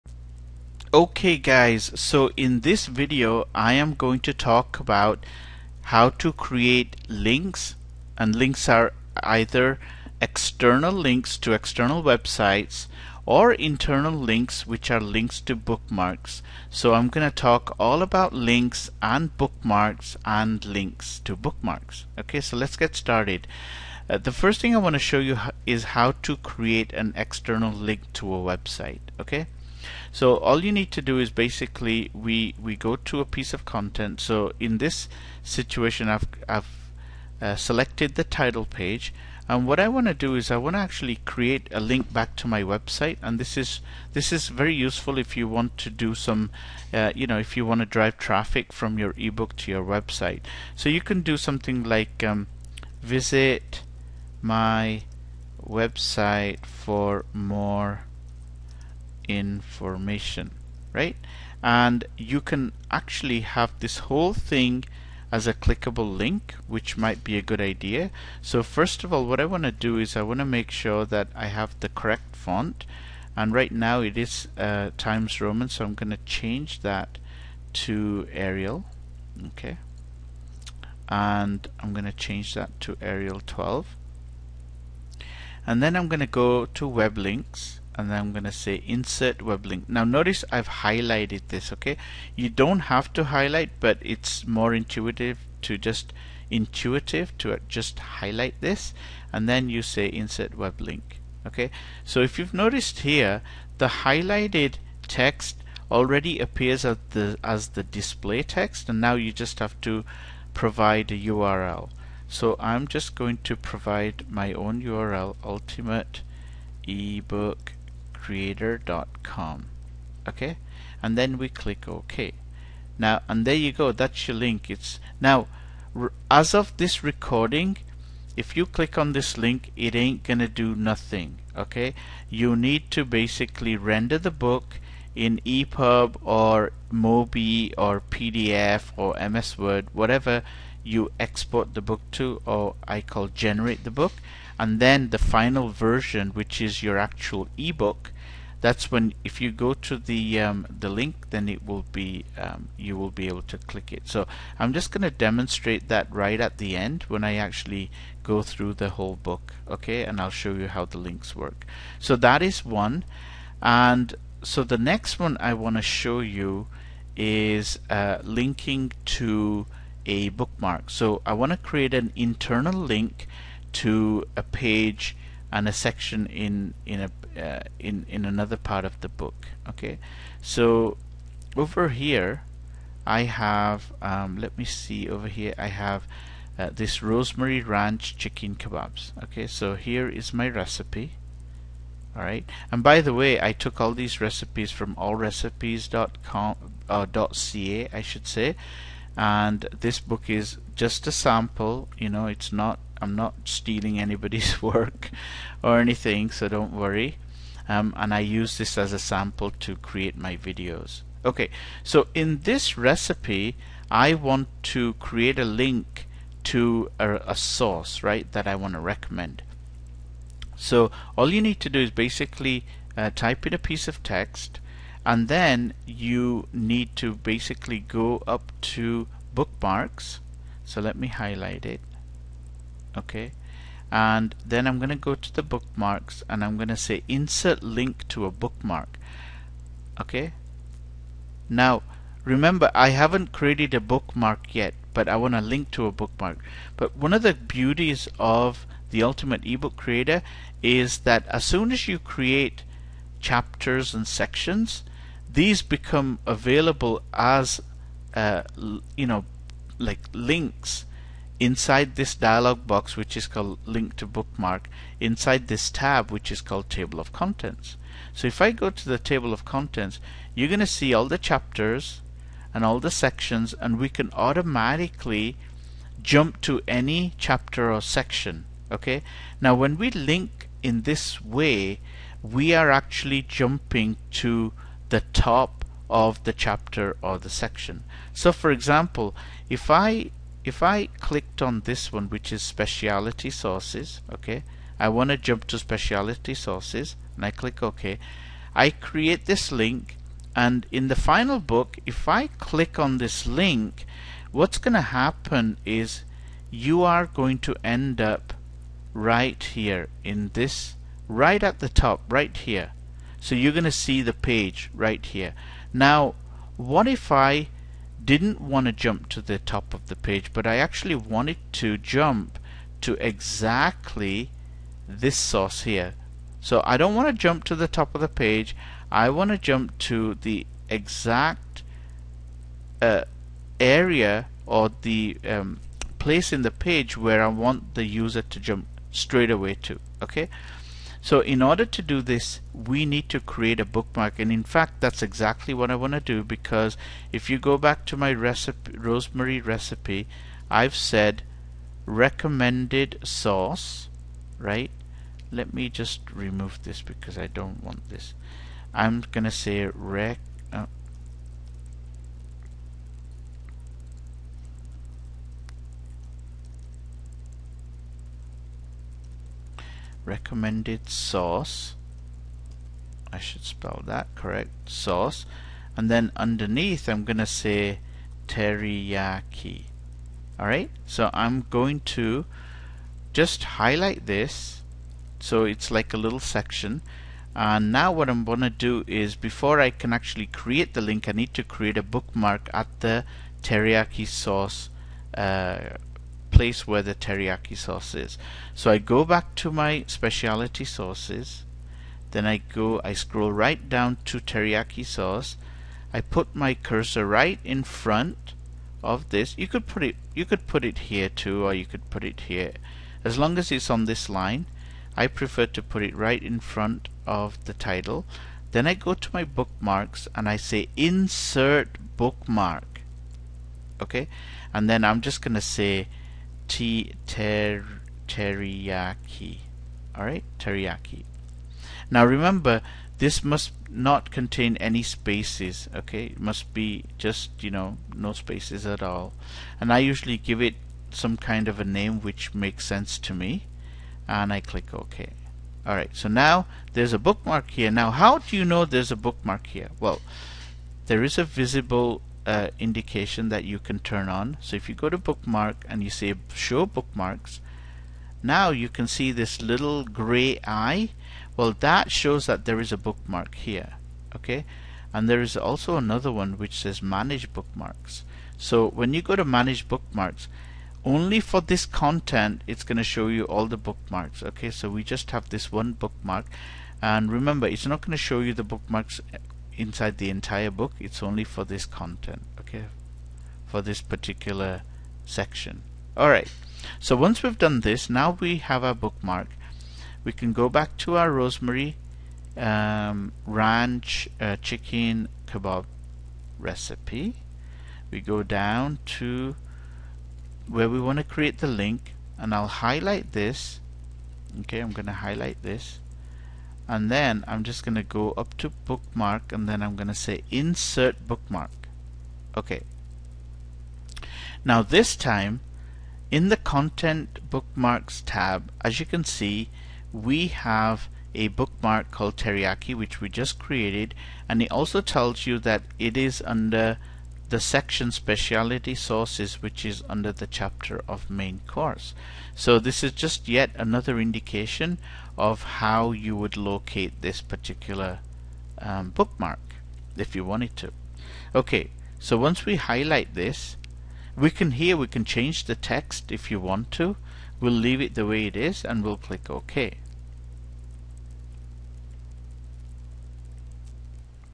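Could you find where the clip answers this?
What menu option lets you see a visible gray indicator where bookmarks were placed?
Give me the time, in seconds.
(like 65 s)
456 s.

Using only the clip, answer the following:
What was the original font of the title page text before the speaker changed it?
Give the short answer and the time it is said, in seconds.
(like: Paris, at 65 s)
Times Roman, at 74 s.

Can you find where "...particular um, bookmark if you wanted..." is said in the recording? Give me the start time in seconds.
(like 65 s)
537 s.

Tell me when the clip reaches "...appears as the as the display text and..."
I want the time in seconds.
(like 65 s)
106 s.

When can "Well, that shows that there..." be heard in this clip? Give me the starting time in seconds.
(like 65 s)
461 s.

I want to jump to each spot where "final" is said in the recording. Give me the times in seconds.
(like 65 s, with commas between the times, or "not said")
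145 s, 300 s.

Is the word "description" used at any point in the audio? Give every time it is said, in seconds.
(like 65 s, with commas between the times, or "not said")
not said.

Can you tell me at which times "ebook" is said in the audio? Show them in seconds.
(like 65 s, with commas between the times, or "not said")
49 s, 116 s, 147 s, 249 s.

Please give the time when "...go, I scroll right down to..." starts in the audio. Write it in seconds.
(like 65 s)
402 s.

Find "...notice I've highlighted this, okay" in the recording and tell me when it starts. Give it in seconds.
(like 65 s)
90 s.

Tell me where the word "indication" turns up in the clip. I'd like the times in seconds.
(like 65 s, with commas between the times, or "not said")
452 s, 534 s.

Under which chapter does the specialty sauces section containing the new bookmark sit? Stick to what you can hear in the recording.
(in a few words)
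Main course.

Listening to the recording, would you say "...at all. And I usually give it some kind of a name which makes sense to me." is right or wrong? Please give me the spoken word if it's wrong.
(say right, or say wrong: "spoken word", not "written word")
right.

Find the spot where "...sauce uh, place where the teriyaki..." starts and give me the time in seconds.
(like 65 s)
394 s.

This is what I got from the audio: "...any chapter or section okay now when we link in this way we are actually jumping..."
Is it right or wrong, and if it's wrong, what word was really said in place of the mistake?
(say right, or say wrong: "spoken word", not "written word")
right.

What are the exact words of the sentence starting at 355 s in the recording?
Let me just remove this because I don't want this.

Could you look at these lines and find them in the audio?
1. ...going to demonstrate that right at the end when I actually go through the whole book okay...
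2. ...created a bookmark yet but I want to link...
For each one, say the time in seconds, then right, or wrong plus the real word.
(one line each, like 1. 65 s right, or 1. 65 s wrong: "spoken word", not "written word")
1. 154 s right
2. 243 s right.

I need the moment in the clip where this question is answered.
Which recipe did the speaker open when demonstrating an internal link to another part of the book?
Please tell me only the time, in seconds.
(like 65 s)
187 s.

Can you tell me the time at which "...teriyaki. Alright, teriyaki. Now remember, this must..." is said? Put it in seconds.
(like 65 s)
428 s.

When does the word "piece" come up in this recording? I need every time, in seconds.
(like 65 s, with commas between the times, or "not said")
33 s, 223 s.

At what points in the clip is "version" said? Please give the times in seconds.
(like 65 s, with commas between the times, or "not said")
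145 s.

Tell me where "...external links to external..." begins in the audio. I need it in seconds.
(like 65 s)
10 s.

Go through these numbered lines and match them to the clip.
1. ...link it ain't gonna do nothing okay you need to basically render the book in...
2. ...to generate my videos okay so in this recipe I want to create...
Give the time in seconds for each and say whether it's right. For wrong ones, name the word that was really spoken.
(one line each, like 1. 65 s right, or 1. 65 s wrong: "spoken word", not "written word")
1. 129 s right
2. 209 s wrong: "create", not "generate".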